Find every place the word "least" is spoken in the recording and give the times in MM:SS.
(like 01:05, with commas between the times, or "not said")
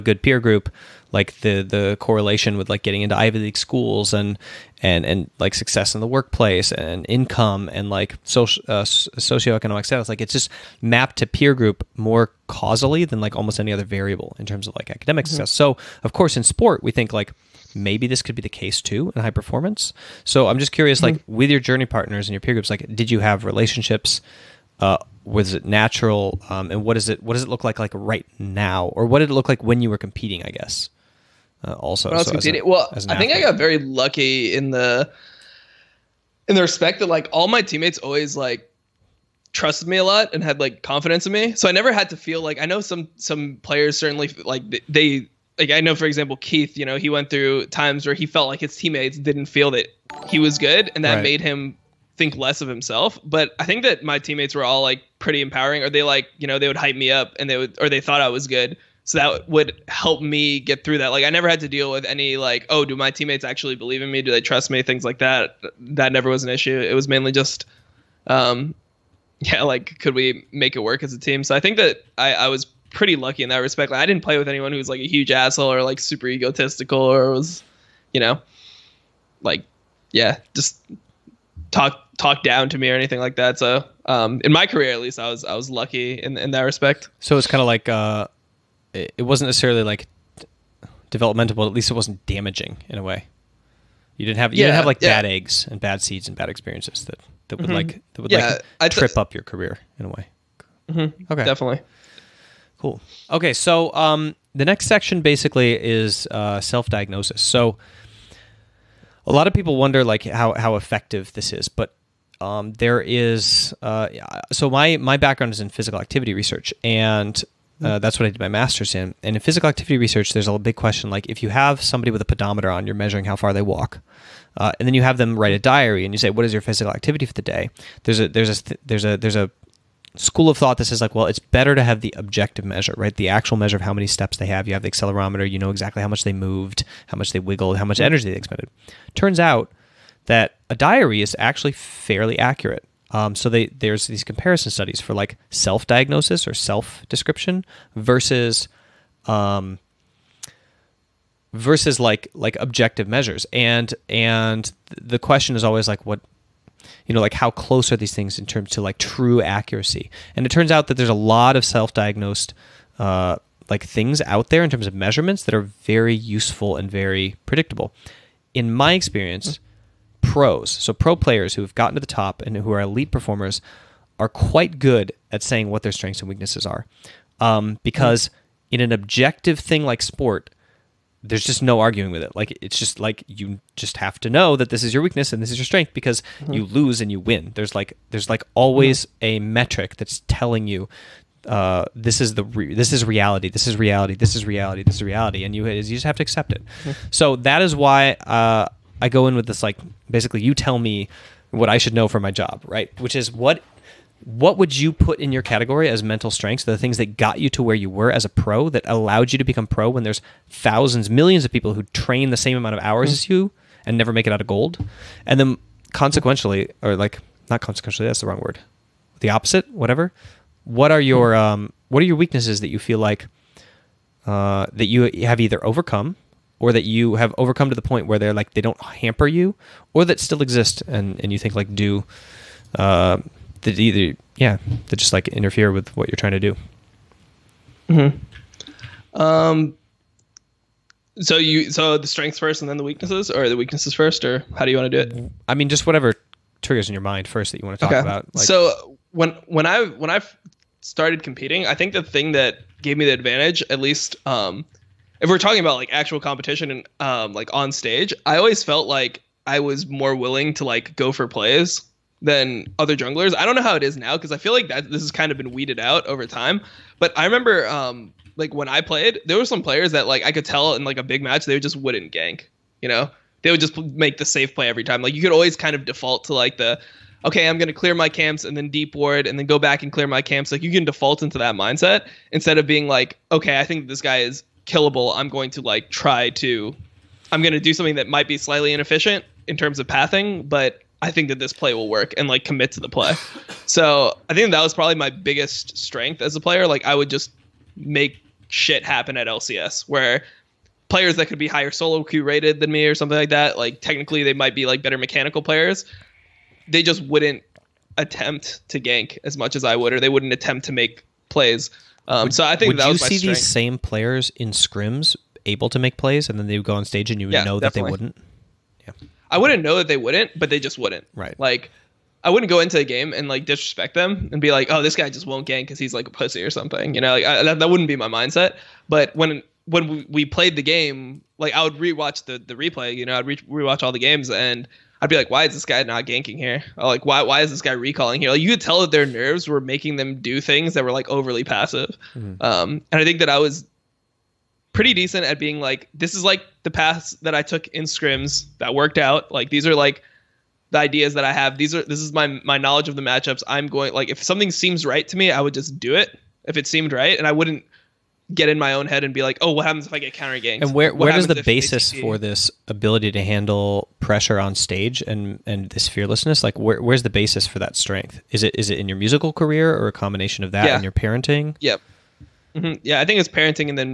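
01:24, 01:31, 04:13.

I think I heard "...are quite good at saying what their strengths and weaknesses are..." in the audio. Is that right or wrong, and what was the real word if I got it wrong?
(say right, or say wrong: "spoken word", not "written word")
right.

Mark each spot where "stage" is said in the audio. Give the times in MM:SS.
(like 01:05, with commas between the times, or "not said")
04:17, 05:16, 06:04.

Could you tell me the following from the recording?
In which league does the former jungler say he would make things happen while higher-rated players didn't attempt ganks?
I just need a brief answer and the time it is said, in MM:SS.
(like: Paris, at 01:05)
LCS, at 04:59.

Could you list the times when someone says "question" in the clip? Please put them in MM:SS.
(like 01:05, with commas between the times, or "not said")
02:00, 02:35.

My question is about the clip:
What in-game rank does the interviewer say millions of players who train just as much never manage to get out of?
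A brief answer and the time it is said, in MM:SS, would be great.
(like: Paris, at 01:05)
gold, at 03:34.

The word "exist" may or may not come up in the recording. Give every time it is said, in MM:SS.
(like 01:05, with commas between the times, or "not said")
03:50.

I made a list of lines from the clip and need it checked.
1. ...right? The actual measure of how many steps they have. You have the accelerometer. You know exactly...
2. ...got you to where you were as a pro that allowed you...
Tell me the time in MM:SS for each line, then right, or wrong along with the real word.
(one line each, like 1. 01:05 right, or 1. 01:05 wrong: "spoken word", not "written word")
1. 02:12 right
2. 03:27 right.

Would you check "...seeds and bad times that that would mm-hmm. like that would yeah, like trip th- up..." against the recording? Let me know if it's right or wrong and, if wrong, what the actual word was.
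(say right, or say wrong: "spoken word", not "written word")
wrong: "experiences", not "times".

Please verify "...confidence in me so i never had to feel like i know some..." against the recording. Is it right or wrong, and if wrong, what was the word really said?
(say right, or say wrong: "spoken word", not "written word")
right.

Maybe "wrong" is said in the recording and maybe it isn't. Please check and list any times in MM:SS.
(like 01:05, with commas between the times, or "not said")
03:38.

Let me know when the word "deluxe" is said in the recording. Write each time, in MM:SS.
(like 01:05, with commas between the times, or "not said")
not said.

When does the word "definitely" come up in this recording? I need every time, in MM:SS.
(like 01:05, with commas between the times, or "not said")
01:41, 05:17.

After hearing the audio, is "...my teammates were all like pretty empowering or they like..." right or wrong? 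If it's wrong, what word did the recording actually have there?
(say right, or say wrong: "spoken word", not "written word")
right.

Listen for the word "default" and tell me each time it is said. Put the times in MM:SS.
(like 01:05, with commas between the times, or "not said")
04:35, 04:40.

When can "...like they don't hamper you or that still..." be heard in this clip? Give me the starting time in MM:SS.
03:48.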